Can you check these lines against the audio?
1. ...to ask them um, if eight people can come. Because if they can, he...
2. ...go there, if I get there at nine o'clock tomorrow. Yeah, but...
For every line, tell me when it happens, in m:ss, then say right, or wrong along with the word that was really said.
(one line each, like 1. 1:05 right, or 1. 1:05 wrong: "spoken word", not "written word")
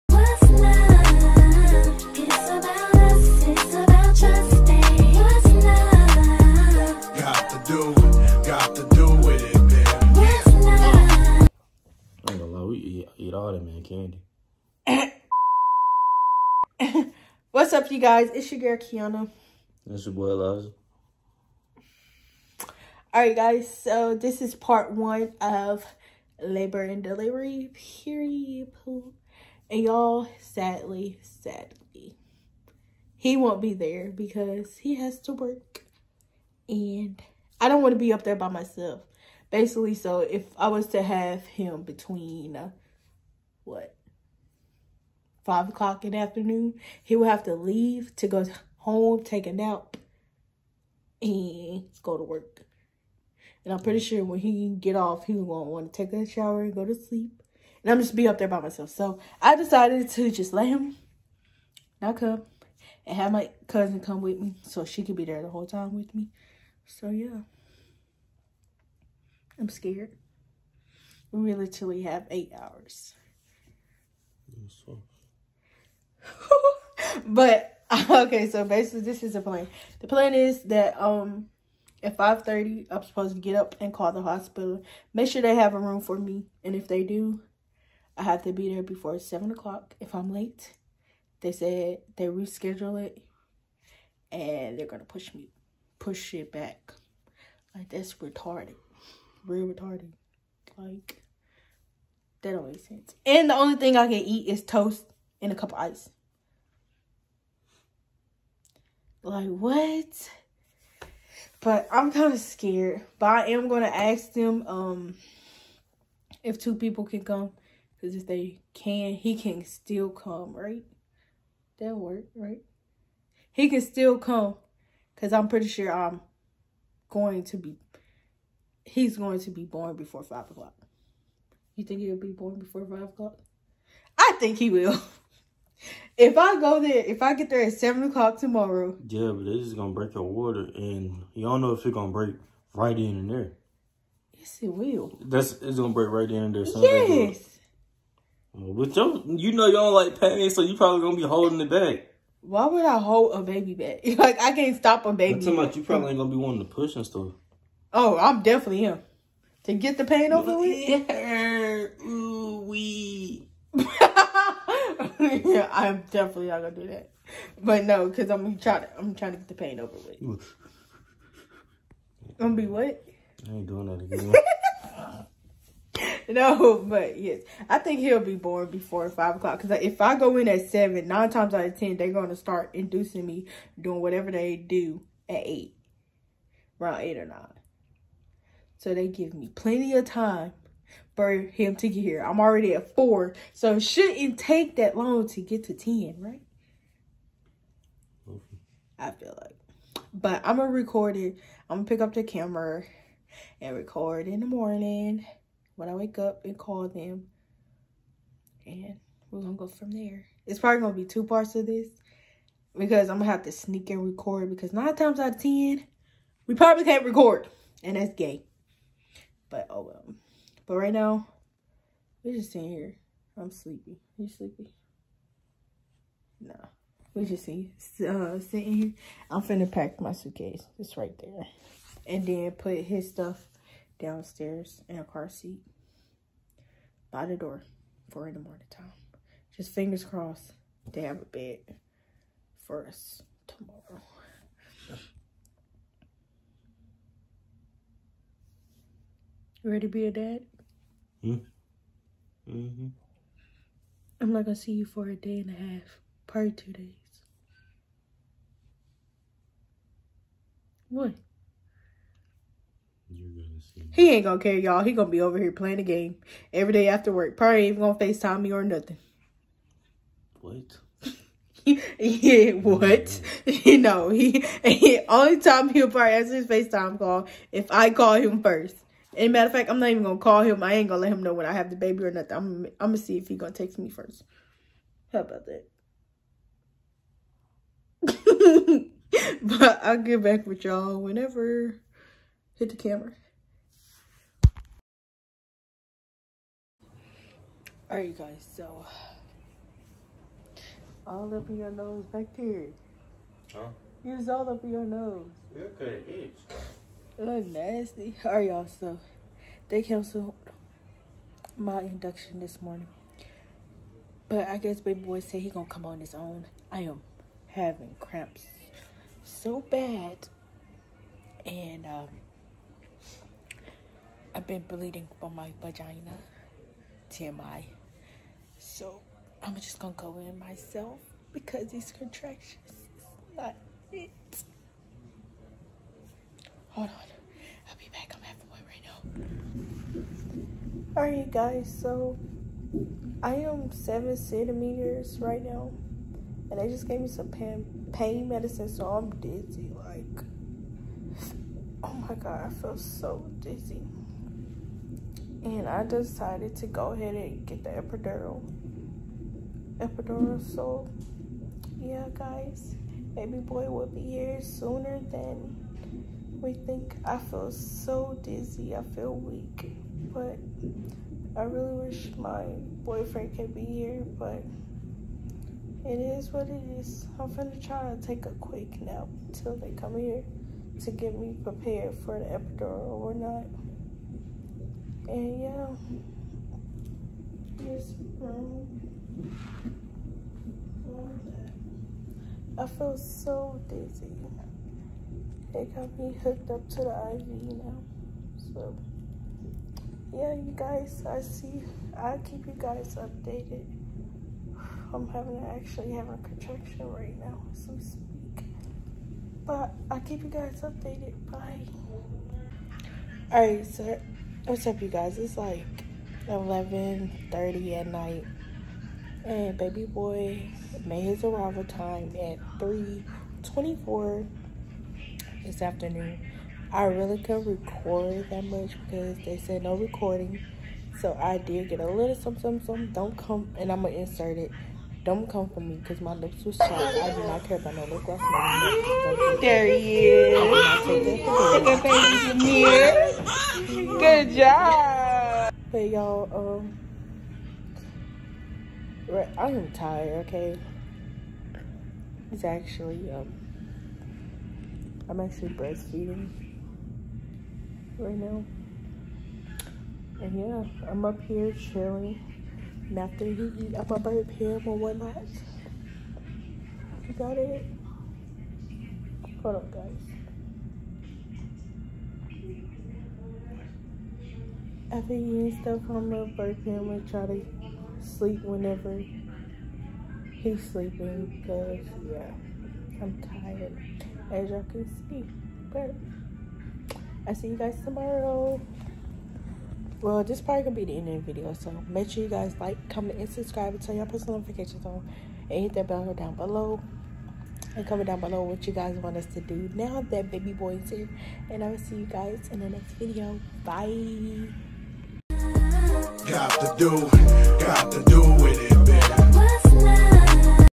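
1. 1:53 wrong: "two", not "eight"
2. 2:16 wrong: "seven", not "nine".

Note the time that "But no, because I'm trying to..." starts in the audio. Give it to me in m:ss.
2:47.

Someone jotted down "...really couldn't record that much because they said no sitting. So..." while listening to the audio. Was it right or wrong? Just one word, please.
wrong.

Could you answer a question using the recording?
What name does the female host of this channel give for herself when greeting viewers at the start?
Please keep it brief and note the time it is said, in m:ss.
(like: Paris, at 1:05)
Kiana, at 0:18.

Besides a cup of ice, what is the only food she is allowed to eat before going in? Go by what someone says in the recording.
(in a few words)
Toast.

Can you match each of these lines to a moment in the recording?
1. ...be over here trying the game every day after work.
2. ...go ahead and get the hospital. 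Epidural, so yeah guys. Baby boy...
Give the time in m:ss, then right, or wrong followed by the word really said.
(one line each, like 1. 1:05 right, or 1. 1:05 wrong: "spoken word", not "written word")
1. 4:25 wrong: "playing", not "trying"
2. 5:56 wrong: "epidural", not "hospital".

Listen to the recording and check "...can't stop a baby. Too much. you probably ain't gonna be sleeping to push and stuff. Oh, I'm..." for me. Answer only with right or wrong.
wrong.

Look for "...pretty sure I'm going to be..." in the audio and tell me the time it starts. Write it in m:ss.
2:05.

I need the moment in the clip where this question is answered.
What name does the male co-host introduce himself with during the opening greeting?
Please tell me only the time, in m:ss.
0:20.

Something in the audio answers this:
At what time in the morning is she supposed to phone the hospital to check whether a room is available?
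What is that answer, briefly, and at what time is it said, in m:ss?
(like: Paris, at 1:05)
5:30, at 1:22.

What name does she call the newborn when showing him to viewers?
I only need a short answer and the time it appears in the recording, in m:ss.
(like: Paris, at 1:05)
Jameer, at 7:22.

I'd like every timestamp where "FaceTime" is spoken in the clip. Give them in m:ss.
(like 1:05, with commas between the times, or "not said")
4:27, 4:36.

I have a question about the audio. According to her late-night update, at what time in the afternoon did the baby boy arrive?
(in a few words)
3:24.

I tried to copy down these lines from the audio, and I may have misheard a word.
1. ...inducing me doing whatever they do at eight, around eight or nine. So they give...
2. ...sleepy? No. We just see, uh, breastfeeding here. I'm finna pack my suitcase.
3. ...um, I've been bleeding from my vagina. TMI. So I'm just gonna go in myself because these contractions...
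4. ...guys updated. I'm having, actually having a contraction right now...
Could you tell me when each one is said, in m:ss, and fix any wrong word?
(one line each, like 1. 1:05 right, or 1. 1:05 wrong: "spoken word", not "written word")
1. 3:02 right
2. 3:44 wrong: "sitting", not "breastfeeding"
3. 5:21 right
4. 6:42 right.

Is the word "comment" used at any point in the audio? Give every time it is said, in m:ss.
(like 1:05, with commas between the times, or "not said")
8:12, 8:17.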